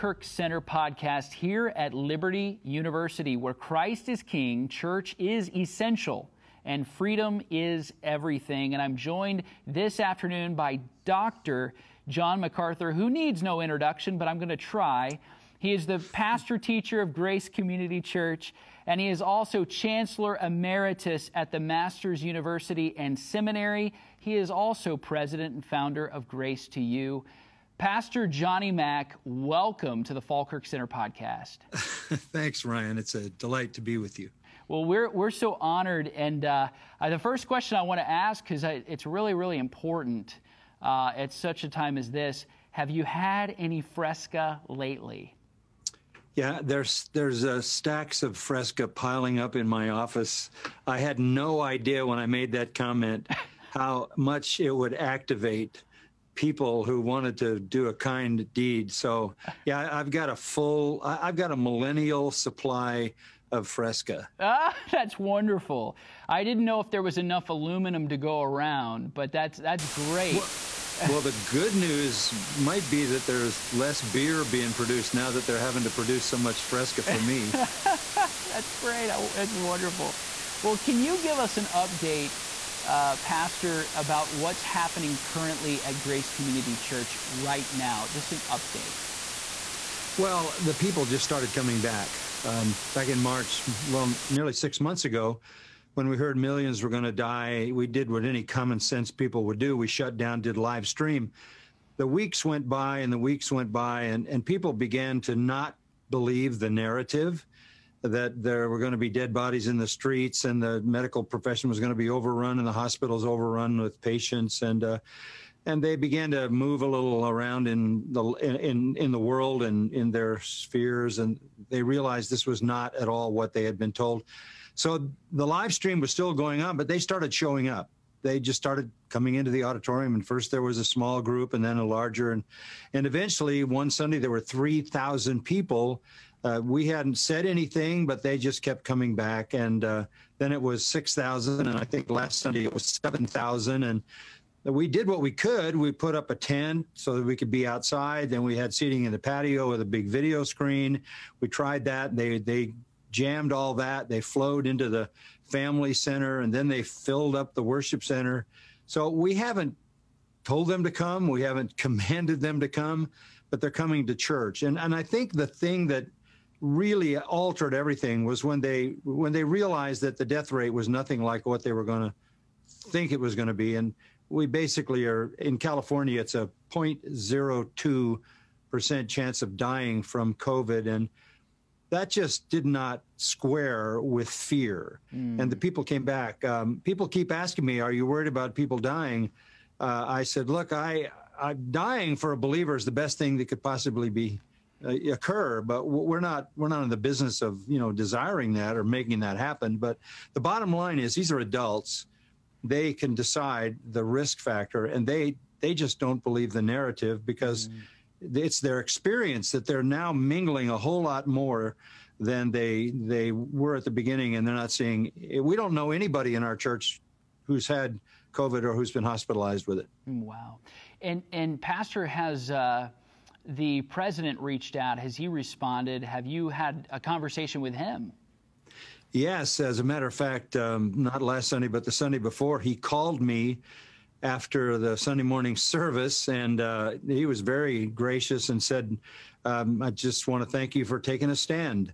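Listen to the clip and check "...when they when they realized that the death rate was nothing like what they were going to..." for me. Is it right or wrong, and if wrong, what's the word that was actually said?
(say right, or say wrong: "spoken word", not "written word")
right.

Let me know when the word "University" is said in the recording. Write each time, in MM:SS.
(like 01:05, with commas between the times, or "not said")
00:02, 00:22.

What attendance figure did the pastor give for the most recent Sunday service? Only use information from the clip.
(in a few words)
7000.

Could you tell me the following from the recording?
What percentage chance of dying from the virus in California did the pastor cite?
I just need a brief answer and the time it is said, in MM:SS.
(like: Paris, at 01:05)
0.02%, at 02:56.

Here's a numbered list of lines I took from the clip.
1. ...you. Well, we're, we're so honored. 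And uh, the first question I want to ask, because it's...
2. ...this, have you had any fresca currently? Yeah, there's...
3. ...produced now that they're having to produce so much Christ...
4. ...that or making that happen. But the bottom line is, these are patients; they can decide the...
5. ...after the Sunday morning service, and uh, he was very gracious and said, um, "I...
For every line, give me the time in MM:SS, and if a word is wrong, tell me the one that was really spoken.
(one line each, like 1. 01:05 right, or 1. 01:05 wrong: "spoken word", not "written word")
1. 00:34 right
2. 00:42 wrong: "lately", not "currently"
3. 01:14 wrong: "Fresca", not "Christ"
4. 03:18 wrong: "adults", not "patients"
5. 03:54 right.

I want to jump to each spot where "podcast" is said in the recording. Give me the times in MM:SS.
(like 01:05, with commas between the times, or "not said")
00:00, 00:30.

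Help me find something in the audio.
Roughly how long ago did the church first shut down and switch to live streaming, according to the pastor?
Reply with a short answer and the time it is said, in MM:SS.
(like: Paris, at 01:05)
nearly 6 months, at 01:34.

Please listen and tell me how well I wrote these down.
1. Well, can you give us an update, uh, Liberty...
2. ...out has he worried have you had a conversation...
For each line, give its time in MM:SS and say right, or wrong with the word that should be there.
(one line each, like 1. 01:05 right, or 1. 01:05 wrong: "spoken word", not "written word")
1. 01:20 wrong: "Pastor", not "Liberty"
2. 03:44 wrong: "responded", not "worried".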